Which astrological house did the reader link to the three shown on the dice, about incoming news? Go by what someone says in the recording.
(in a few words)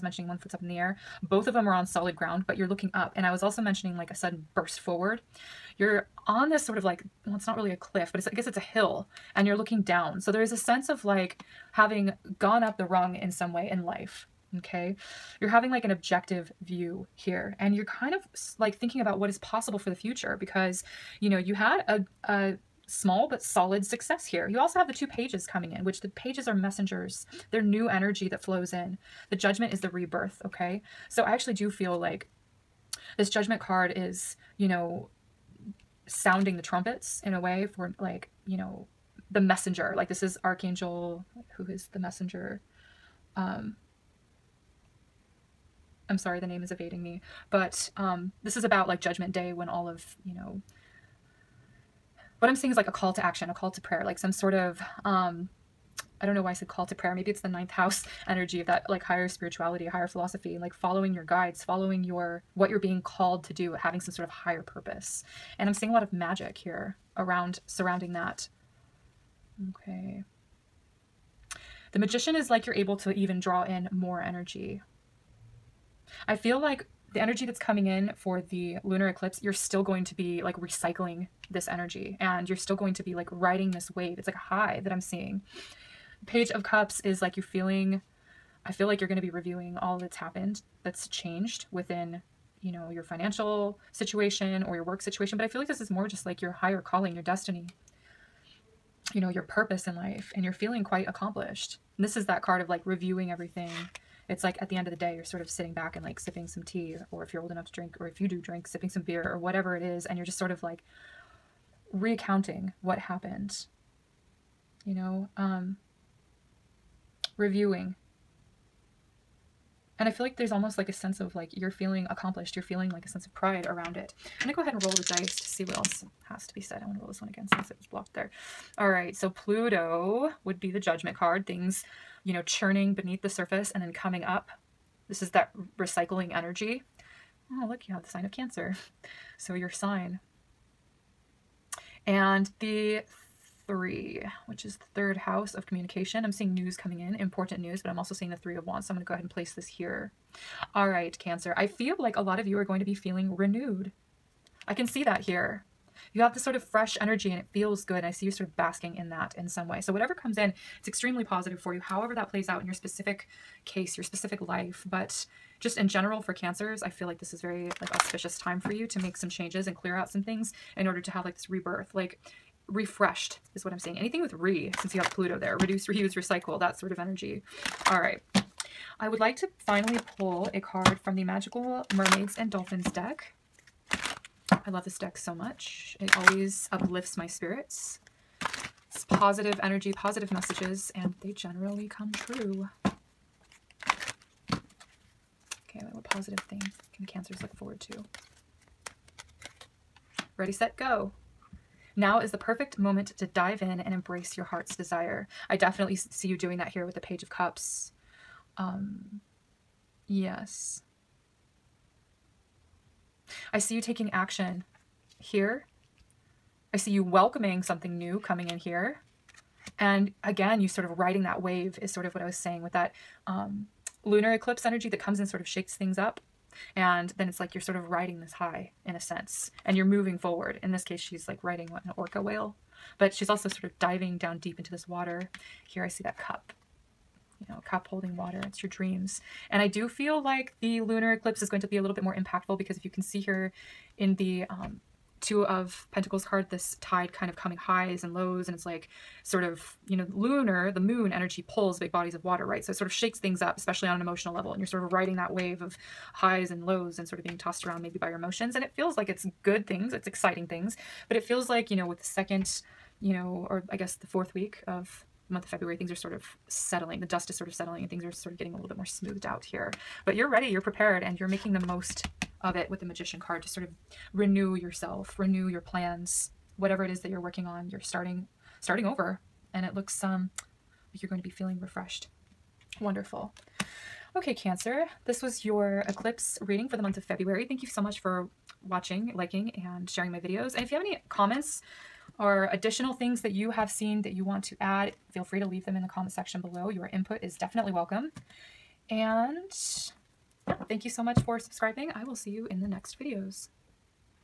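Third house of communication.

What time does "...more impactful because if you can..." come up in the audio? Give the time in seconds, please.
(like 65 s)
242 s.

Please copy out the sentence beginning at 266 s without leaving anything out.
The dust is sort of settling and things are sort of getting a little bit more smoothed out here.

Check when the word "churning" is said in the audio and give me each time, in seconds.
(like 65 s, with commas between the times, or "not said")
132 s.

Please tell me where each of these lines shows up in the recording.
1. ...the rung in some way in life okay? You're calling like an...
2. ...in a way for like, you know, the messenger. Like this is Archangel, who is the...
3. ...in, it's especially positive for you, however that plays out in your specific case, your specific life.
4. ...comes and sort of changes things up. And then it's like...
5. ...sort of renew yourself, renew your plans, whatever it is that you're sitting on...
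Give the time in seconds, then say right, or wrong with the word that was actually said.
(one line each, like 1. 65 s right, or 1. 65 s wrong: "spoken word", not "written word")
1. 12 s wrong: "having", not "calling"
2. 37 s right
3. 160 s wrong: "extremely", not "especially"
4. 224 s wrong: "shakes", not "changes"
5. 273 s wrong: "working", not "sitting".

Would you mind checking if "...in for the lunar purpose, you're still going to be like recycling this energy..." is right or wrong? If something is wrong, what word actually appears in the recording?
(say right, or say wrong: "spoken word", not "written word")
wrong: "eclipse", not "purpose".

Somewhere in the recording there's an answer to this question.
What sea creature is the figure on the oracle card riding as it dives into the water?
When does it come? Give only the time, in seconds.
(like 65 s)
231 s.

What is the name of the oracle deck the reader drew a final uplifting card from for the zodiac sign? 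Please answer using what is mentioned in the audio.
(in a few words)
Magical Mermaids and Dolphins.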